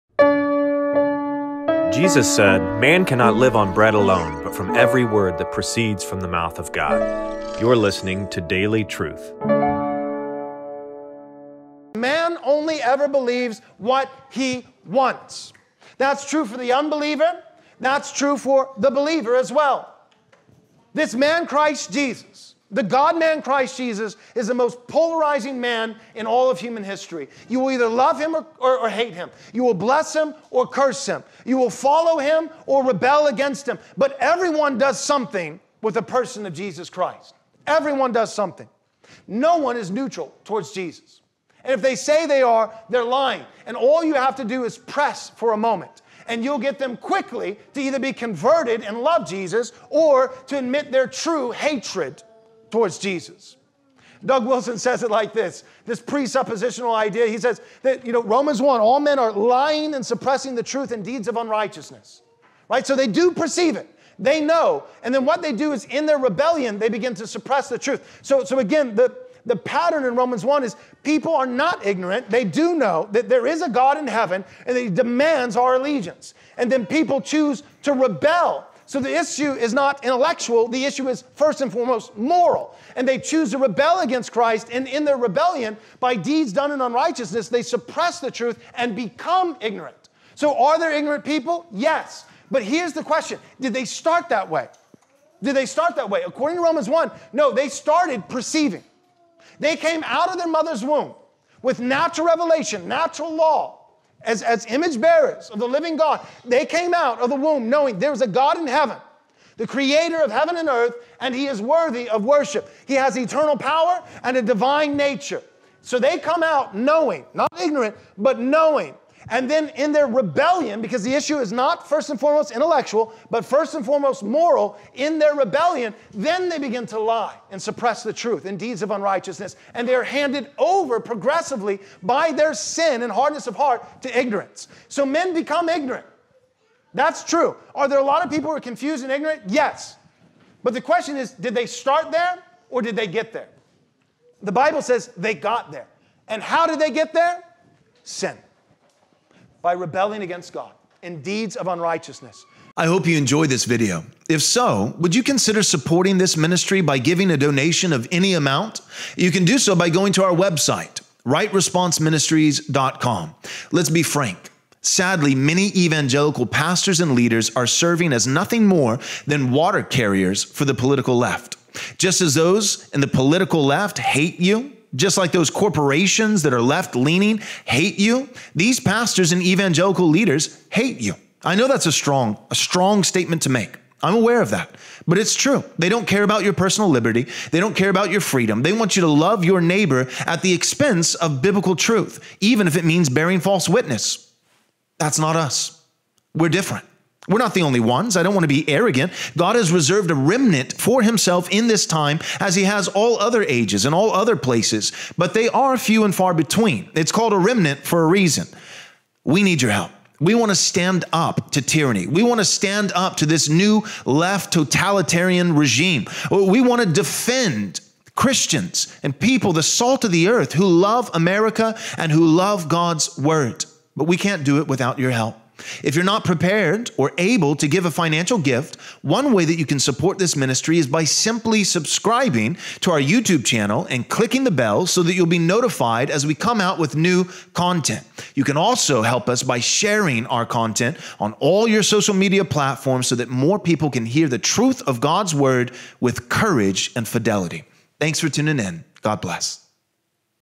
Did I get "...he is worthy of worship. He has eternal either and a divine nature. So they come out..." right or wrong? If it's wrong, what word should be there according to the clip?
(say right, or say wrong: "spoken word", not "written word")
wrong: "power", not "either".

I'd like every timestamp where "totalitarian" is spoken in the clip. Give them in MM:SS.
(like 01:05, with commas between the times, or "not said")
03:34.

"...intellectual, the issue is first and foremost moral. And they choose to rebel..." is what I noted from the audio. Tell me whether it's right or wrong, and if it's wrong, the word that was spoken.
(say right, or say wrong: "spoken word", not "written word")
right.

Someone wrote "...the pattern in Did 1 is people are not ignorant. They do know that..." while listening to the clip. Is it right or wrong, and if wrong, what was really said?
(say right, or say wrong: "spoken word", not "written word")
wrong: "Romans", not "Did".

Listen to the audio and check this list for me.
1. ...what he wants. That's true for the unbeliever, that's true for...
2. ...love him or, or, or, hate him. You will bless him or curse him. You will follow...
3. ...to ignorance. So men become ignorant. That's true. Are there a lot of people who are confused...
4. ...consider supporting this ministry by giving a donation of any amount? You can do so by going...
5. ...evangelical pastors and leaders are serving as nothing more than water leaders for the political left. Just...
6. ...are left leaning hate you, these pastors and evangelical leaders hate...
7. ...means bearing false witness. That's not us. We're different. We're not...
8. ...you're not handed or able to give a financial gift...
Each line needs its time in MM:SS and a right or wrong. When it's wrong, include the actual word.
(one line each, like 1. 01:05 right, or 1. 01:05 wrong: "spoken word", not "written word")
1. 00:13 right
2. 00:27 right
3. 02:14 right
4. 02:35 right
5. 02:45 wrong: "carriers", not "leaders"
6. 02:56 right
7. 03:12 right
8. 03:45 wrong: "prepared", not "handed".